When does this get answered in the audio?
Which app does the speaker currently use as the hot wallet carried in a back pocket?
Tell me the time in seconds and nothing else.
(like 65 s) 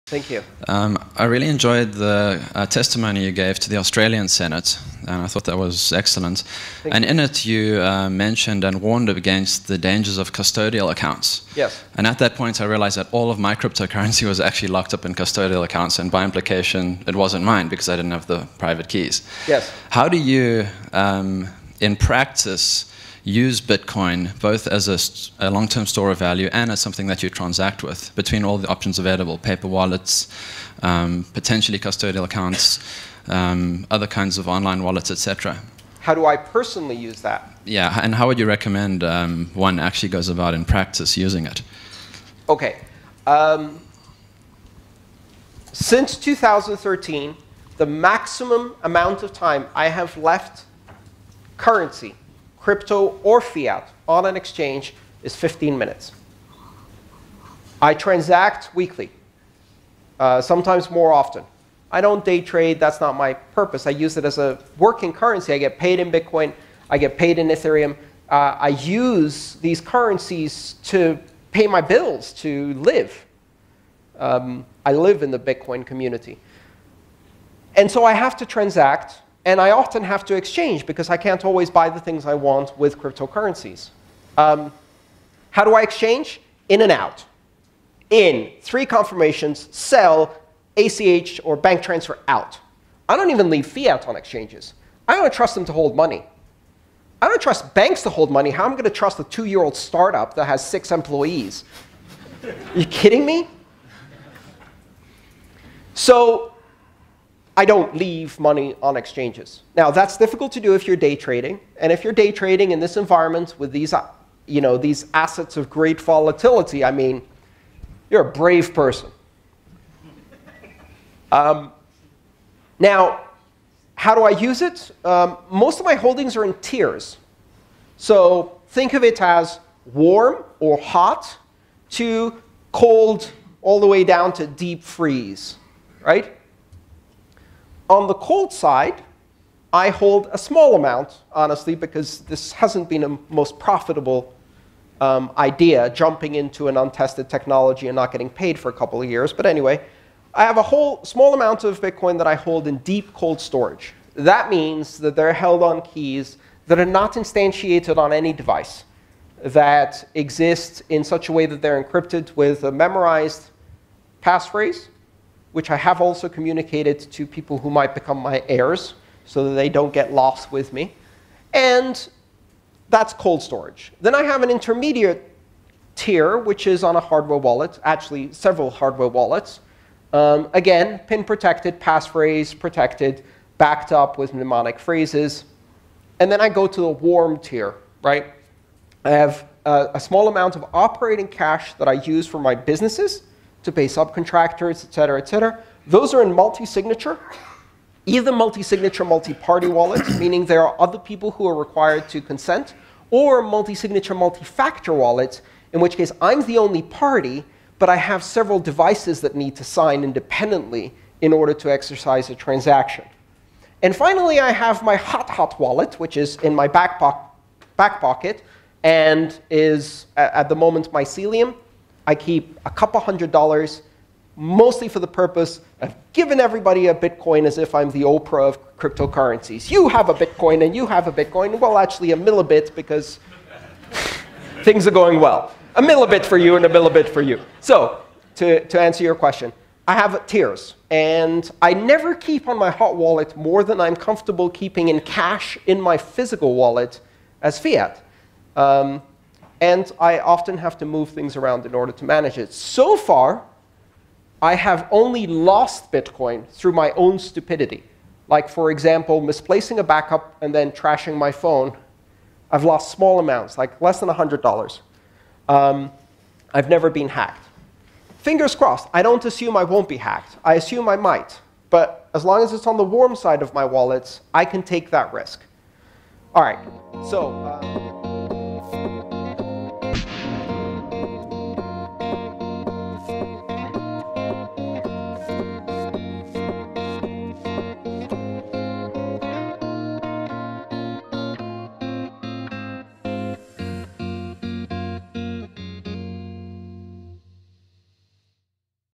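220 s.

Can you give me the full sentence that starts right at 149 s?
But anyway, I have a whole small amount of Bitcoin that I hold in deep cold storage.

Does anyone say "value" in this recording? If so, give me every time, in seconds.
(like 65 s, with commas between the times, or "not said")
26 s.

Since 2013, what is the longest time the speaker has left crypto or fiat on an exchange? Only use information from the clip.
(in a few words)
15 minutes.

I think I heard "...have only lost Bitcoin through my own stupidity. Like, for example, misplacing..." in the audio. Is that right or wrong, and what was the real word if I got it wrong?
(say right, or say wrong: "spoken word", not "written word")
right.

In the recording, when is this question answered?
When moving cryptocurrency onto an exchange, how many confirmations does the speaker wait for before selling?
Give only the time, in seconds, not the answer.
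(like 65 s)
88 s.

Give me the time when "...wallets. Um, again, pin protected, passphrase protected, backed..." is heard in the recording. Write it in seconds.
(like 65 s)
179 s.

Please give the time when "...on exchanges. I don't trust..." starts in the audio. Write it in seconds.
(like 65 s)
94 s.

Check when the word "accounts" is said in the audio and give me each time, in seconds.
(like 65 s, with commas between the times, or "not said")
10 s, 15 s, 32 s.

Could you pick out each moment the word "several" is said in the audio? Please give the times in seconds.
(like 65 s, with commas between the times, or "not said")
178 s, 208 s.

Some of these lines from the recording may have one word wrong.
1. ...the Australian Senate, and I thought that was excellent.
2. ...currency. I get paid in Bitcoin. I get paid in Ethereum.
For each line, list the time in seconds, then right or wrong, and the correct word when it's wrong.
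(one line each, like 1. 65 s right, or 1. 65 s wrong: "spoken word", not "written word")
1. 3 s right
2. 65 s right.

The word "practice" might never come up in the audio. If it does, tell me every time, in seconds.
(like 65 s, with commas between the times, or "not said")
21 s, 40 s.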